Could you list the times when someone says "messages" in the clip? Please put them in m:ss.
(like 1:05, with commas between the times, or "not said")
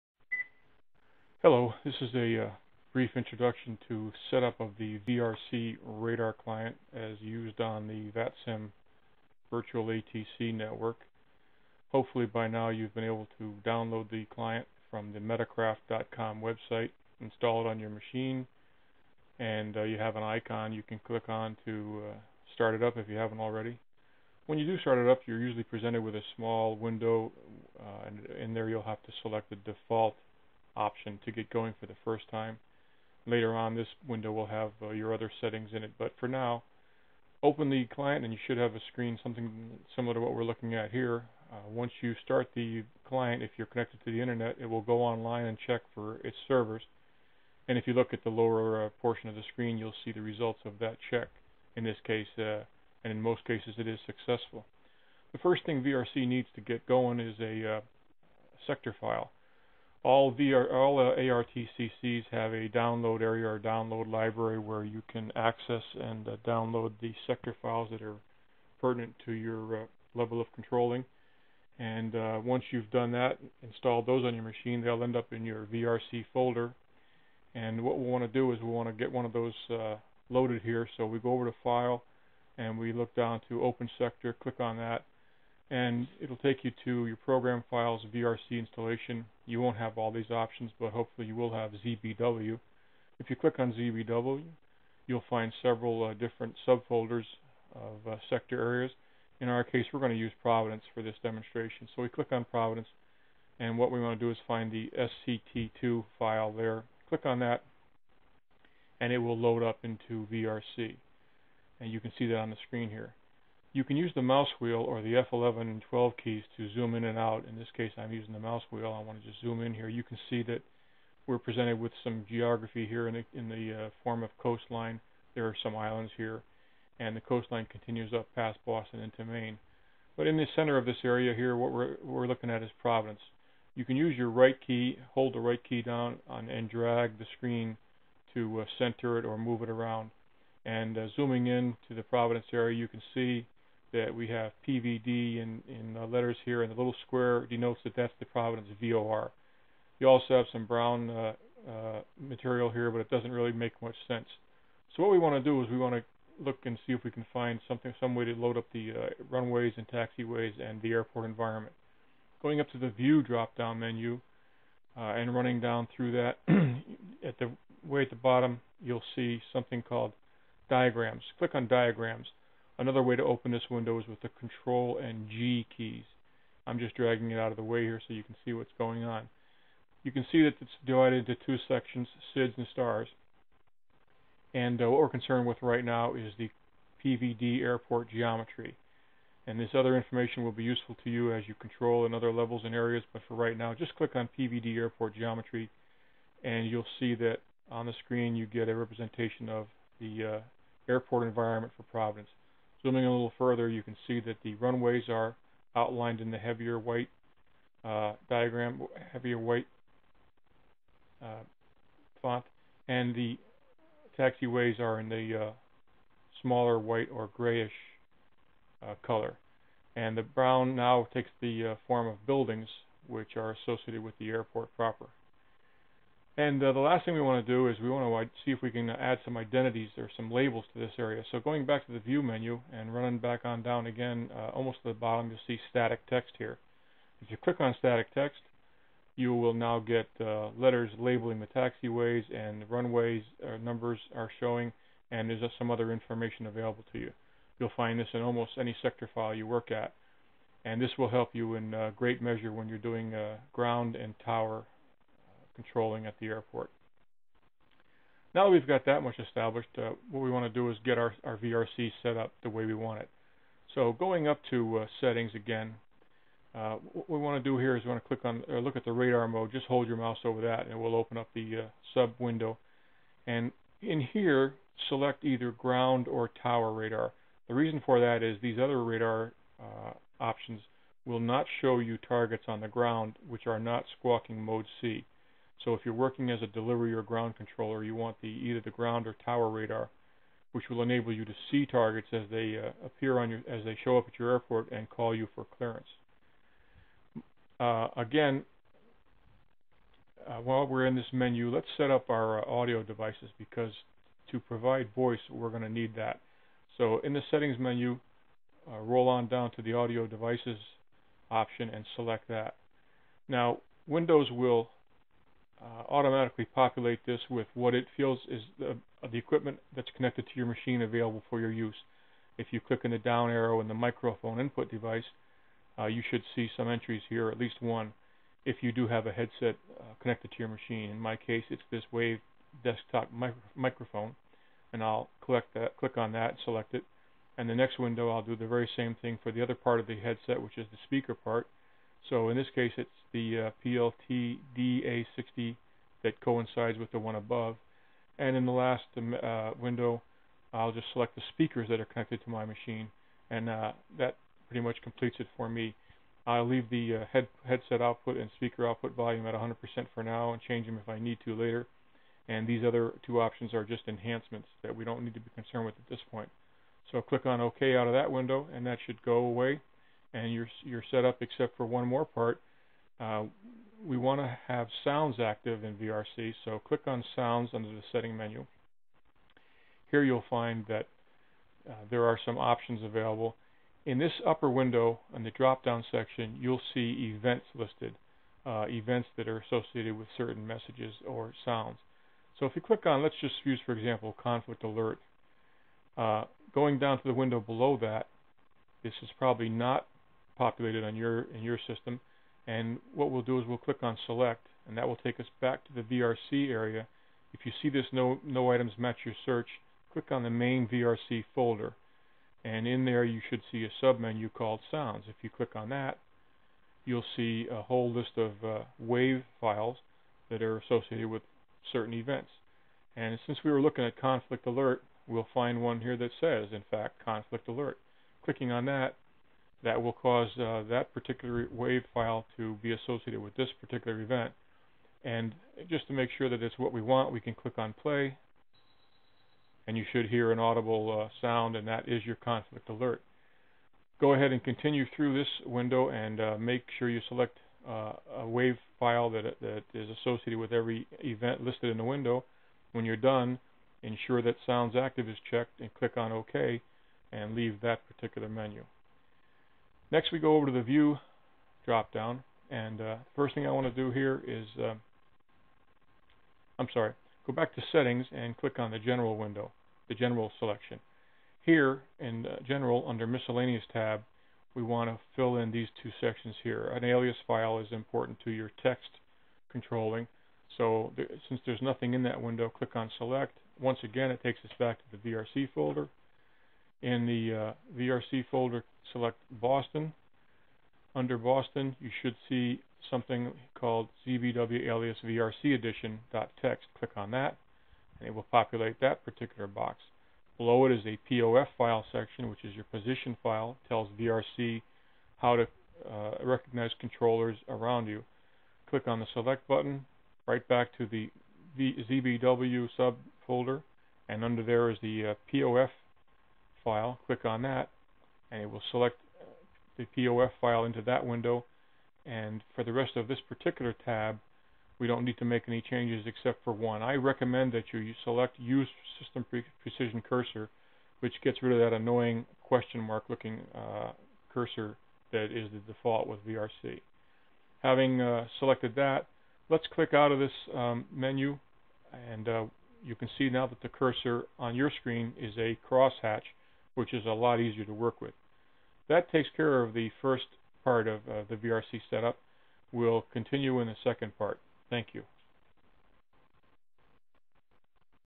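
6:30.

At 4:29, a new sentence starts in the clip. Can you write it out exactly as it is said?
Just hold your mouse over that, and it will open up the uh, sub window.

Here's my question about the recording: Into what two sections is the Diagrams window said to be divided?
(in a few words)
SIDs and STARs.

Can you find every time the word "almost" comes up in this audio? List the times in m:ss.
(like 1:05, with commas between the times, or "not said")
3:54, 4:08.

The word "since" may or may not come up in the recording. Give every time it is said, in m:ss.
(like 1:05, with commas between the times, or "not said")
7:03, 8:01.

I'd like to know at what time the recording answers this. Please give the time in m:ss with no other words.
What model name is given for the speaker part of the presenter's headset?
5:43.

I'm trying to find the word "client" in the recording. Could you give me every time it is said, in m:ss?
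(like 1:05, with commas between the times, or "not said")
0:06, 0:14, 0:37, 0:43.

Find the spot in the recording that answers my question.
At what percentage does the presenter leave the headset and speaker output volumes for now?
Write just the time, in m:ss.
5:59.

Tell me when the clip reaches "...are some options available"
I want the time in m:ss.
6:22.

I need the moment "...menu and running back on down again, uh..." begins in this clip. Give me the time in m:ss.
3:52.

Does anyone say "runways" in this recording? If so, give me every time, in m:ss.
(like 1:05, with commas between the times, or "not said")
2:39, 3:24, 4:02.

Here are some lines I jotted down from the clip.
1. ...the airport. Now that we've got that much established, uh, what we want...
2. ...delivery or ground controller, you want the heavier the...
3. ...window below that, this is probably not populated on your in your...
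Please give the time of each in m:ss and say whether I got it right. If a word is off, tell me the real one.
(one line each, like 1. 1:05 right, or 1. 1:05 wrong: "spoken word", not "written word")
1. 4:16 right
2. 4:46 wrong: "either", not "heavier"
3. 6:37 right.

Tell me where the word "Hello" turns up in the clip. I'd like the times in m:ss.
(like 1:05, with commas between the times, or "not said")
0:01.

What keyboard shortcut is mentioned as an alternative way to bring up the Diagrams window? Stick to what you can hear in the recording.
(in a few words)
Control and G.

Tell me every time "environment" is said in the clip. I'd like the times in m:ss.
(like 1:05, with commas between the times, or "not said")
2:41, 3:21.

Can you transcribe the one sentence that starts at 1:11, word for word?
And uh, once you've done that, installed those on your machine, they'll end up in your VRC folder.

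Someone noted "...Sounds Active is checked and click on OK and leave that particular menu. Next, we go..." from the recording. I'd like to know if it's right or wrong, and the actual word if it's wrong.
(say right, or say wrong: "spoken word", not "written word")
right.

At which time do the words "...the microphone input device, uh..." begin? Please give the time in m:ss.
5:23.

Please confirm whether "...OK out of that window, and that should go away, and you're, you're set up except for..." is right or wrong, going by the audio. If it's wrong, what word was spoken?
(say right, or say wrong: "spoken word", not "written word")
right.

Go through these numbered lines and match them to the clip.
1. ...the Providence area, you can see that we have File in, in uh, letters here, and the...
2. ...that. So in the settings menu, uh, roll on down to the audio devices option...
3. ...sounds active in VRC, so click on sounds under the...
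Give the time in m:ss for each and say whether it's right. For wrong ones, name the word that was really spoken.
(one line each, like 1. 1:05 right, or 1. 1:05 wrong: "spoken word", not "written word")
1. 2:21 wrong: "PVD", not "File"
2. 5:05 right
3. 6:14 right.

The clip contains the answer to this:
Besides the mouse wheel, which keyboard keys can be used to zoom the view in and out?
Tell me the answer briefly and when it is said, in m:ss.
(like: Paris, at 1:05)
F11 and F12, at 1:55.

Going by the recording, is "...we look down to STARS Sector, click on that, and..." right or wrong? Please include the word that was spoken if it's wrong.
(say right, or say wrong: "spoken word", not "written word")
wrong: "Open", not "STARS".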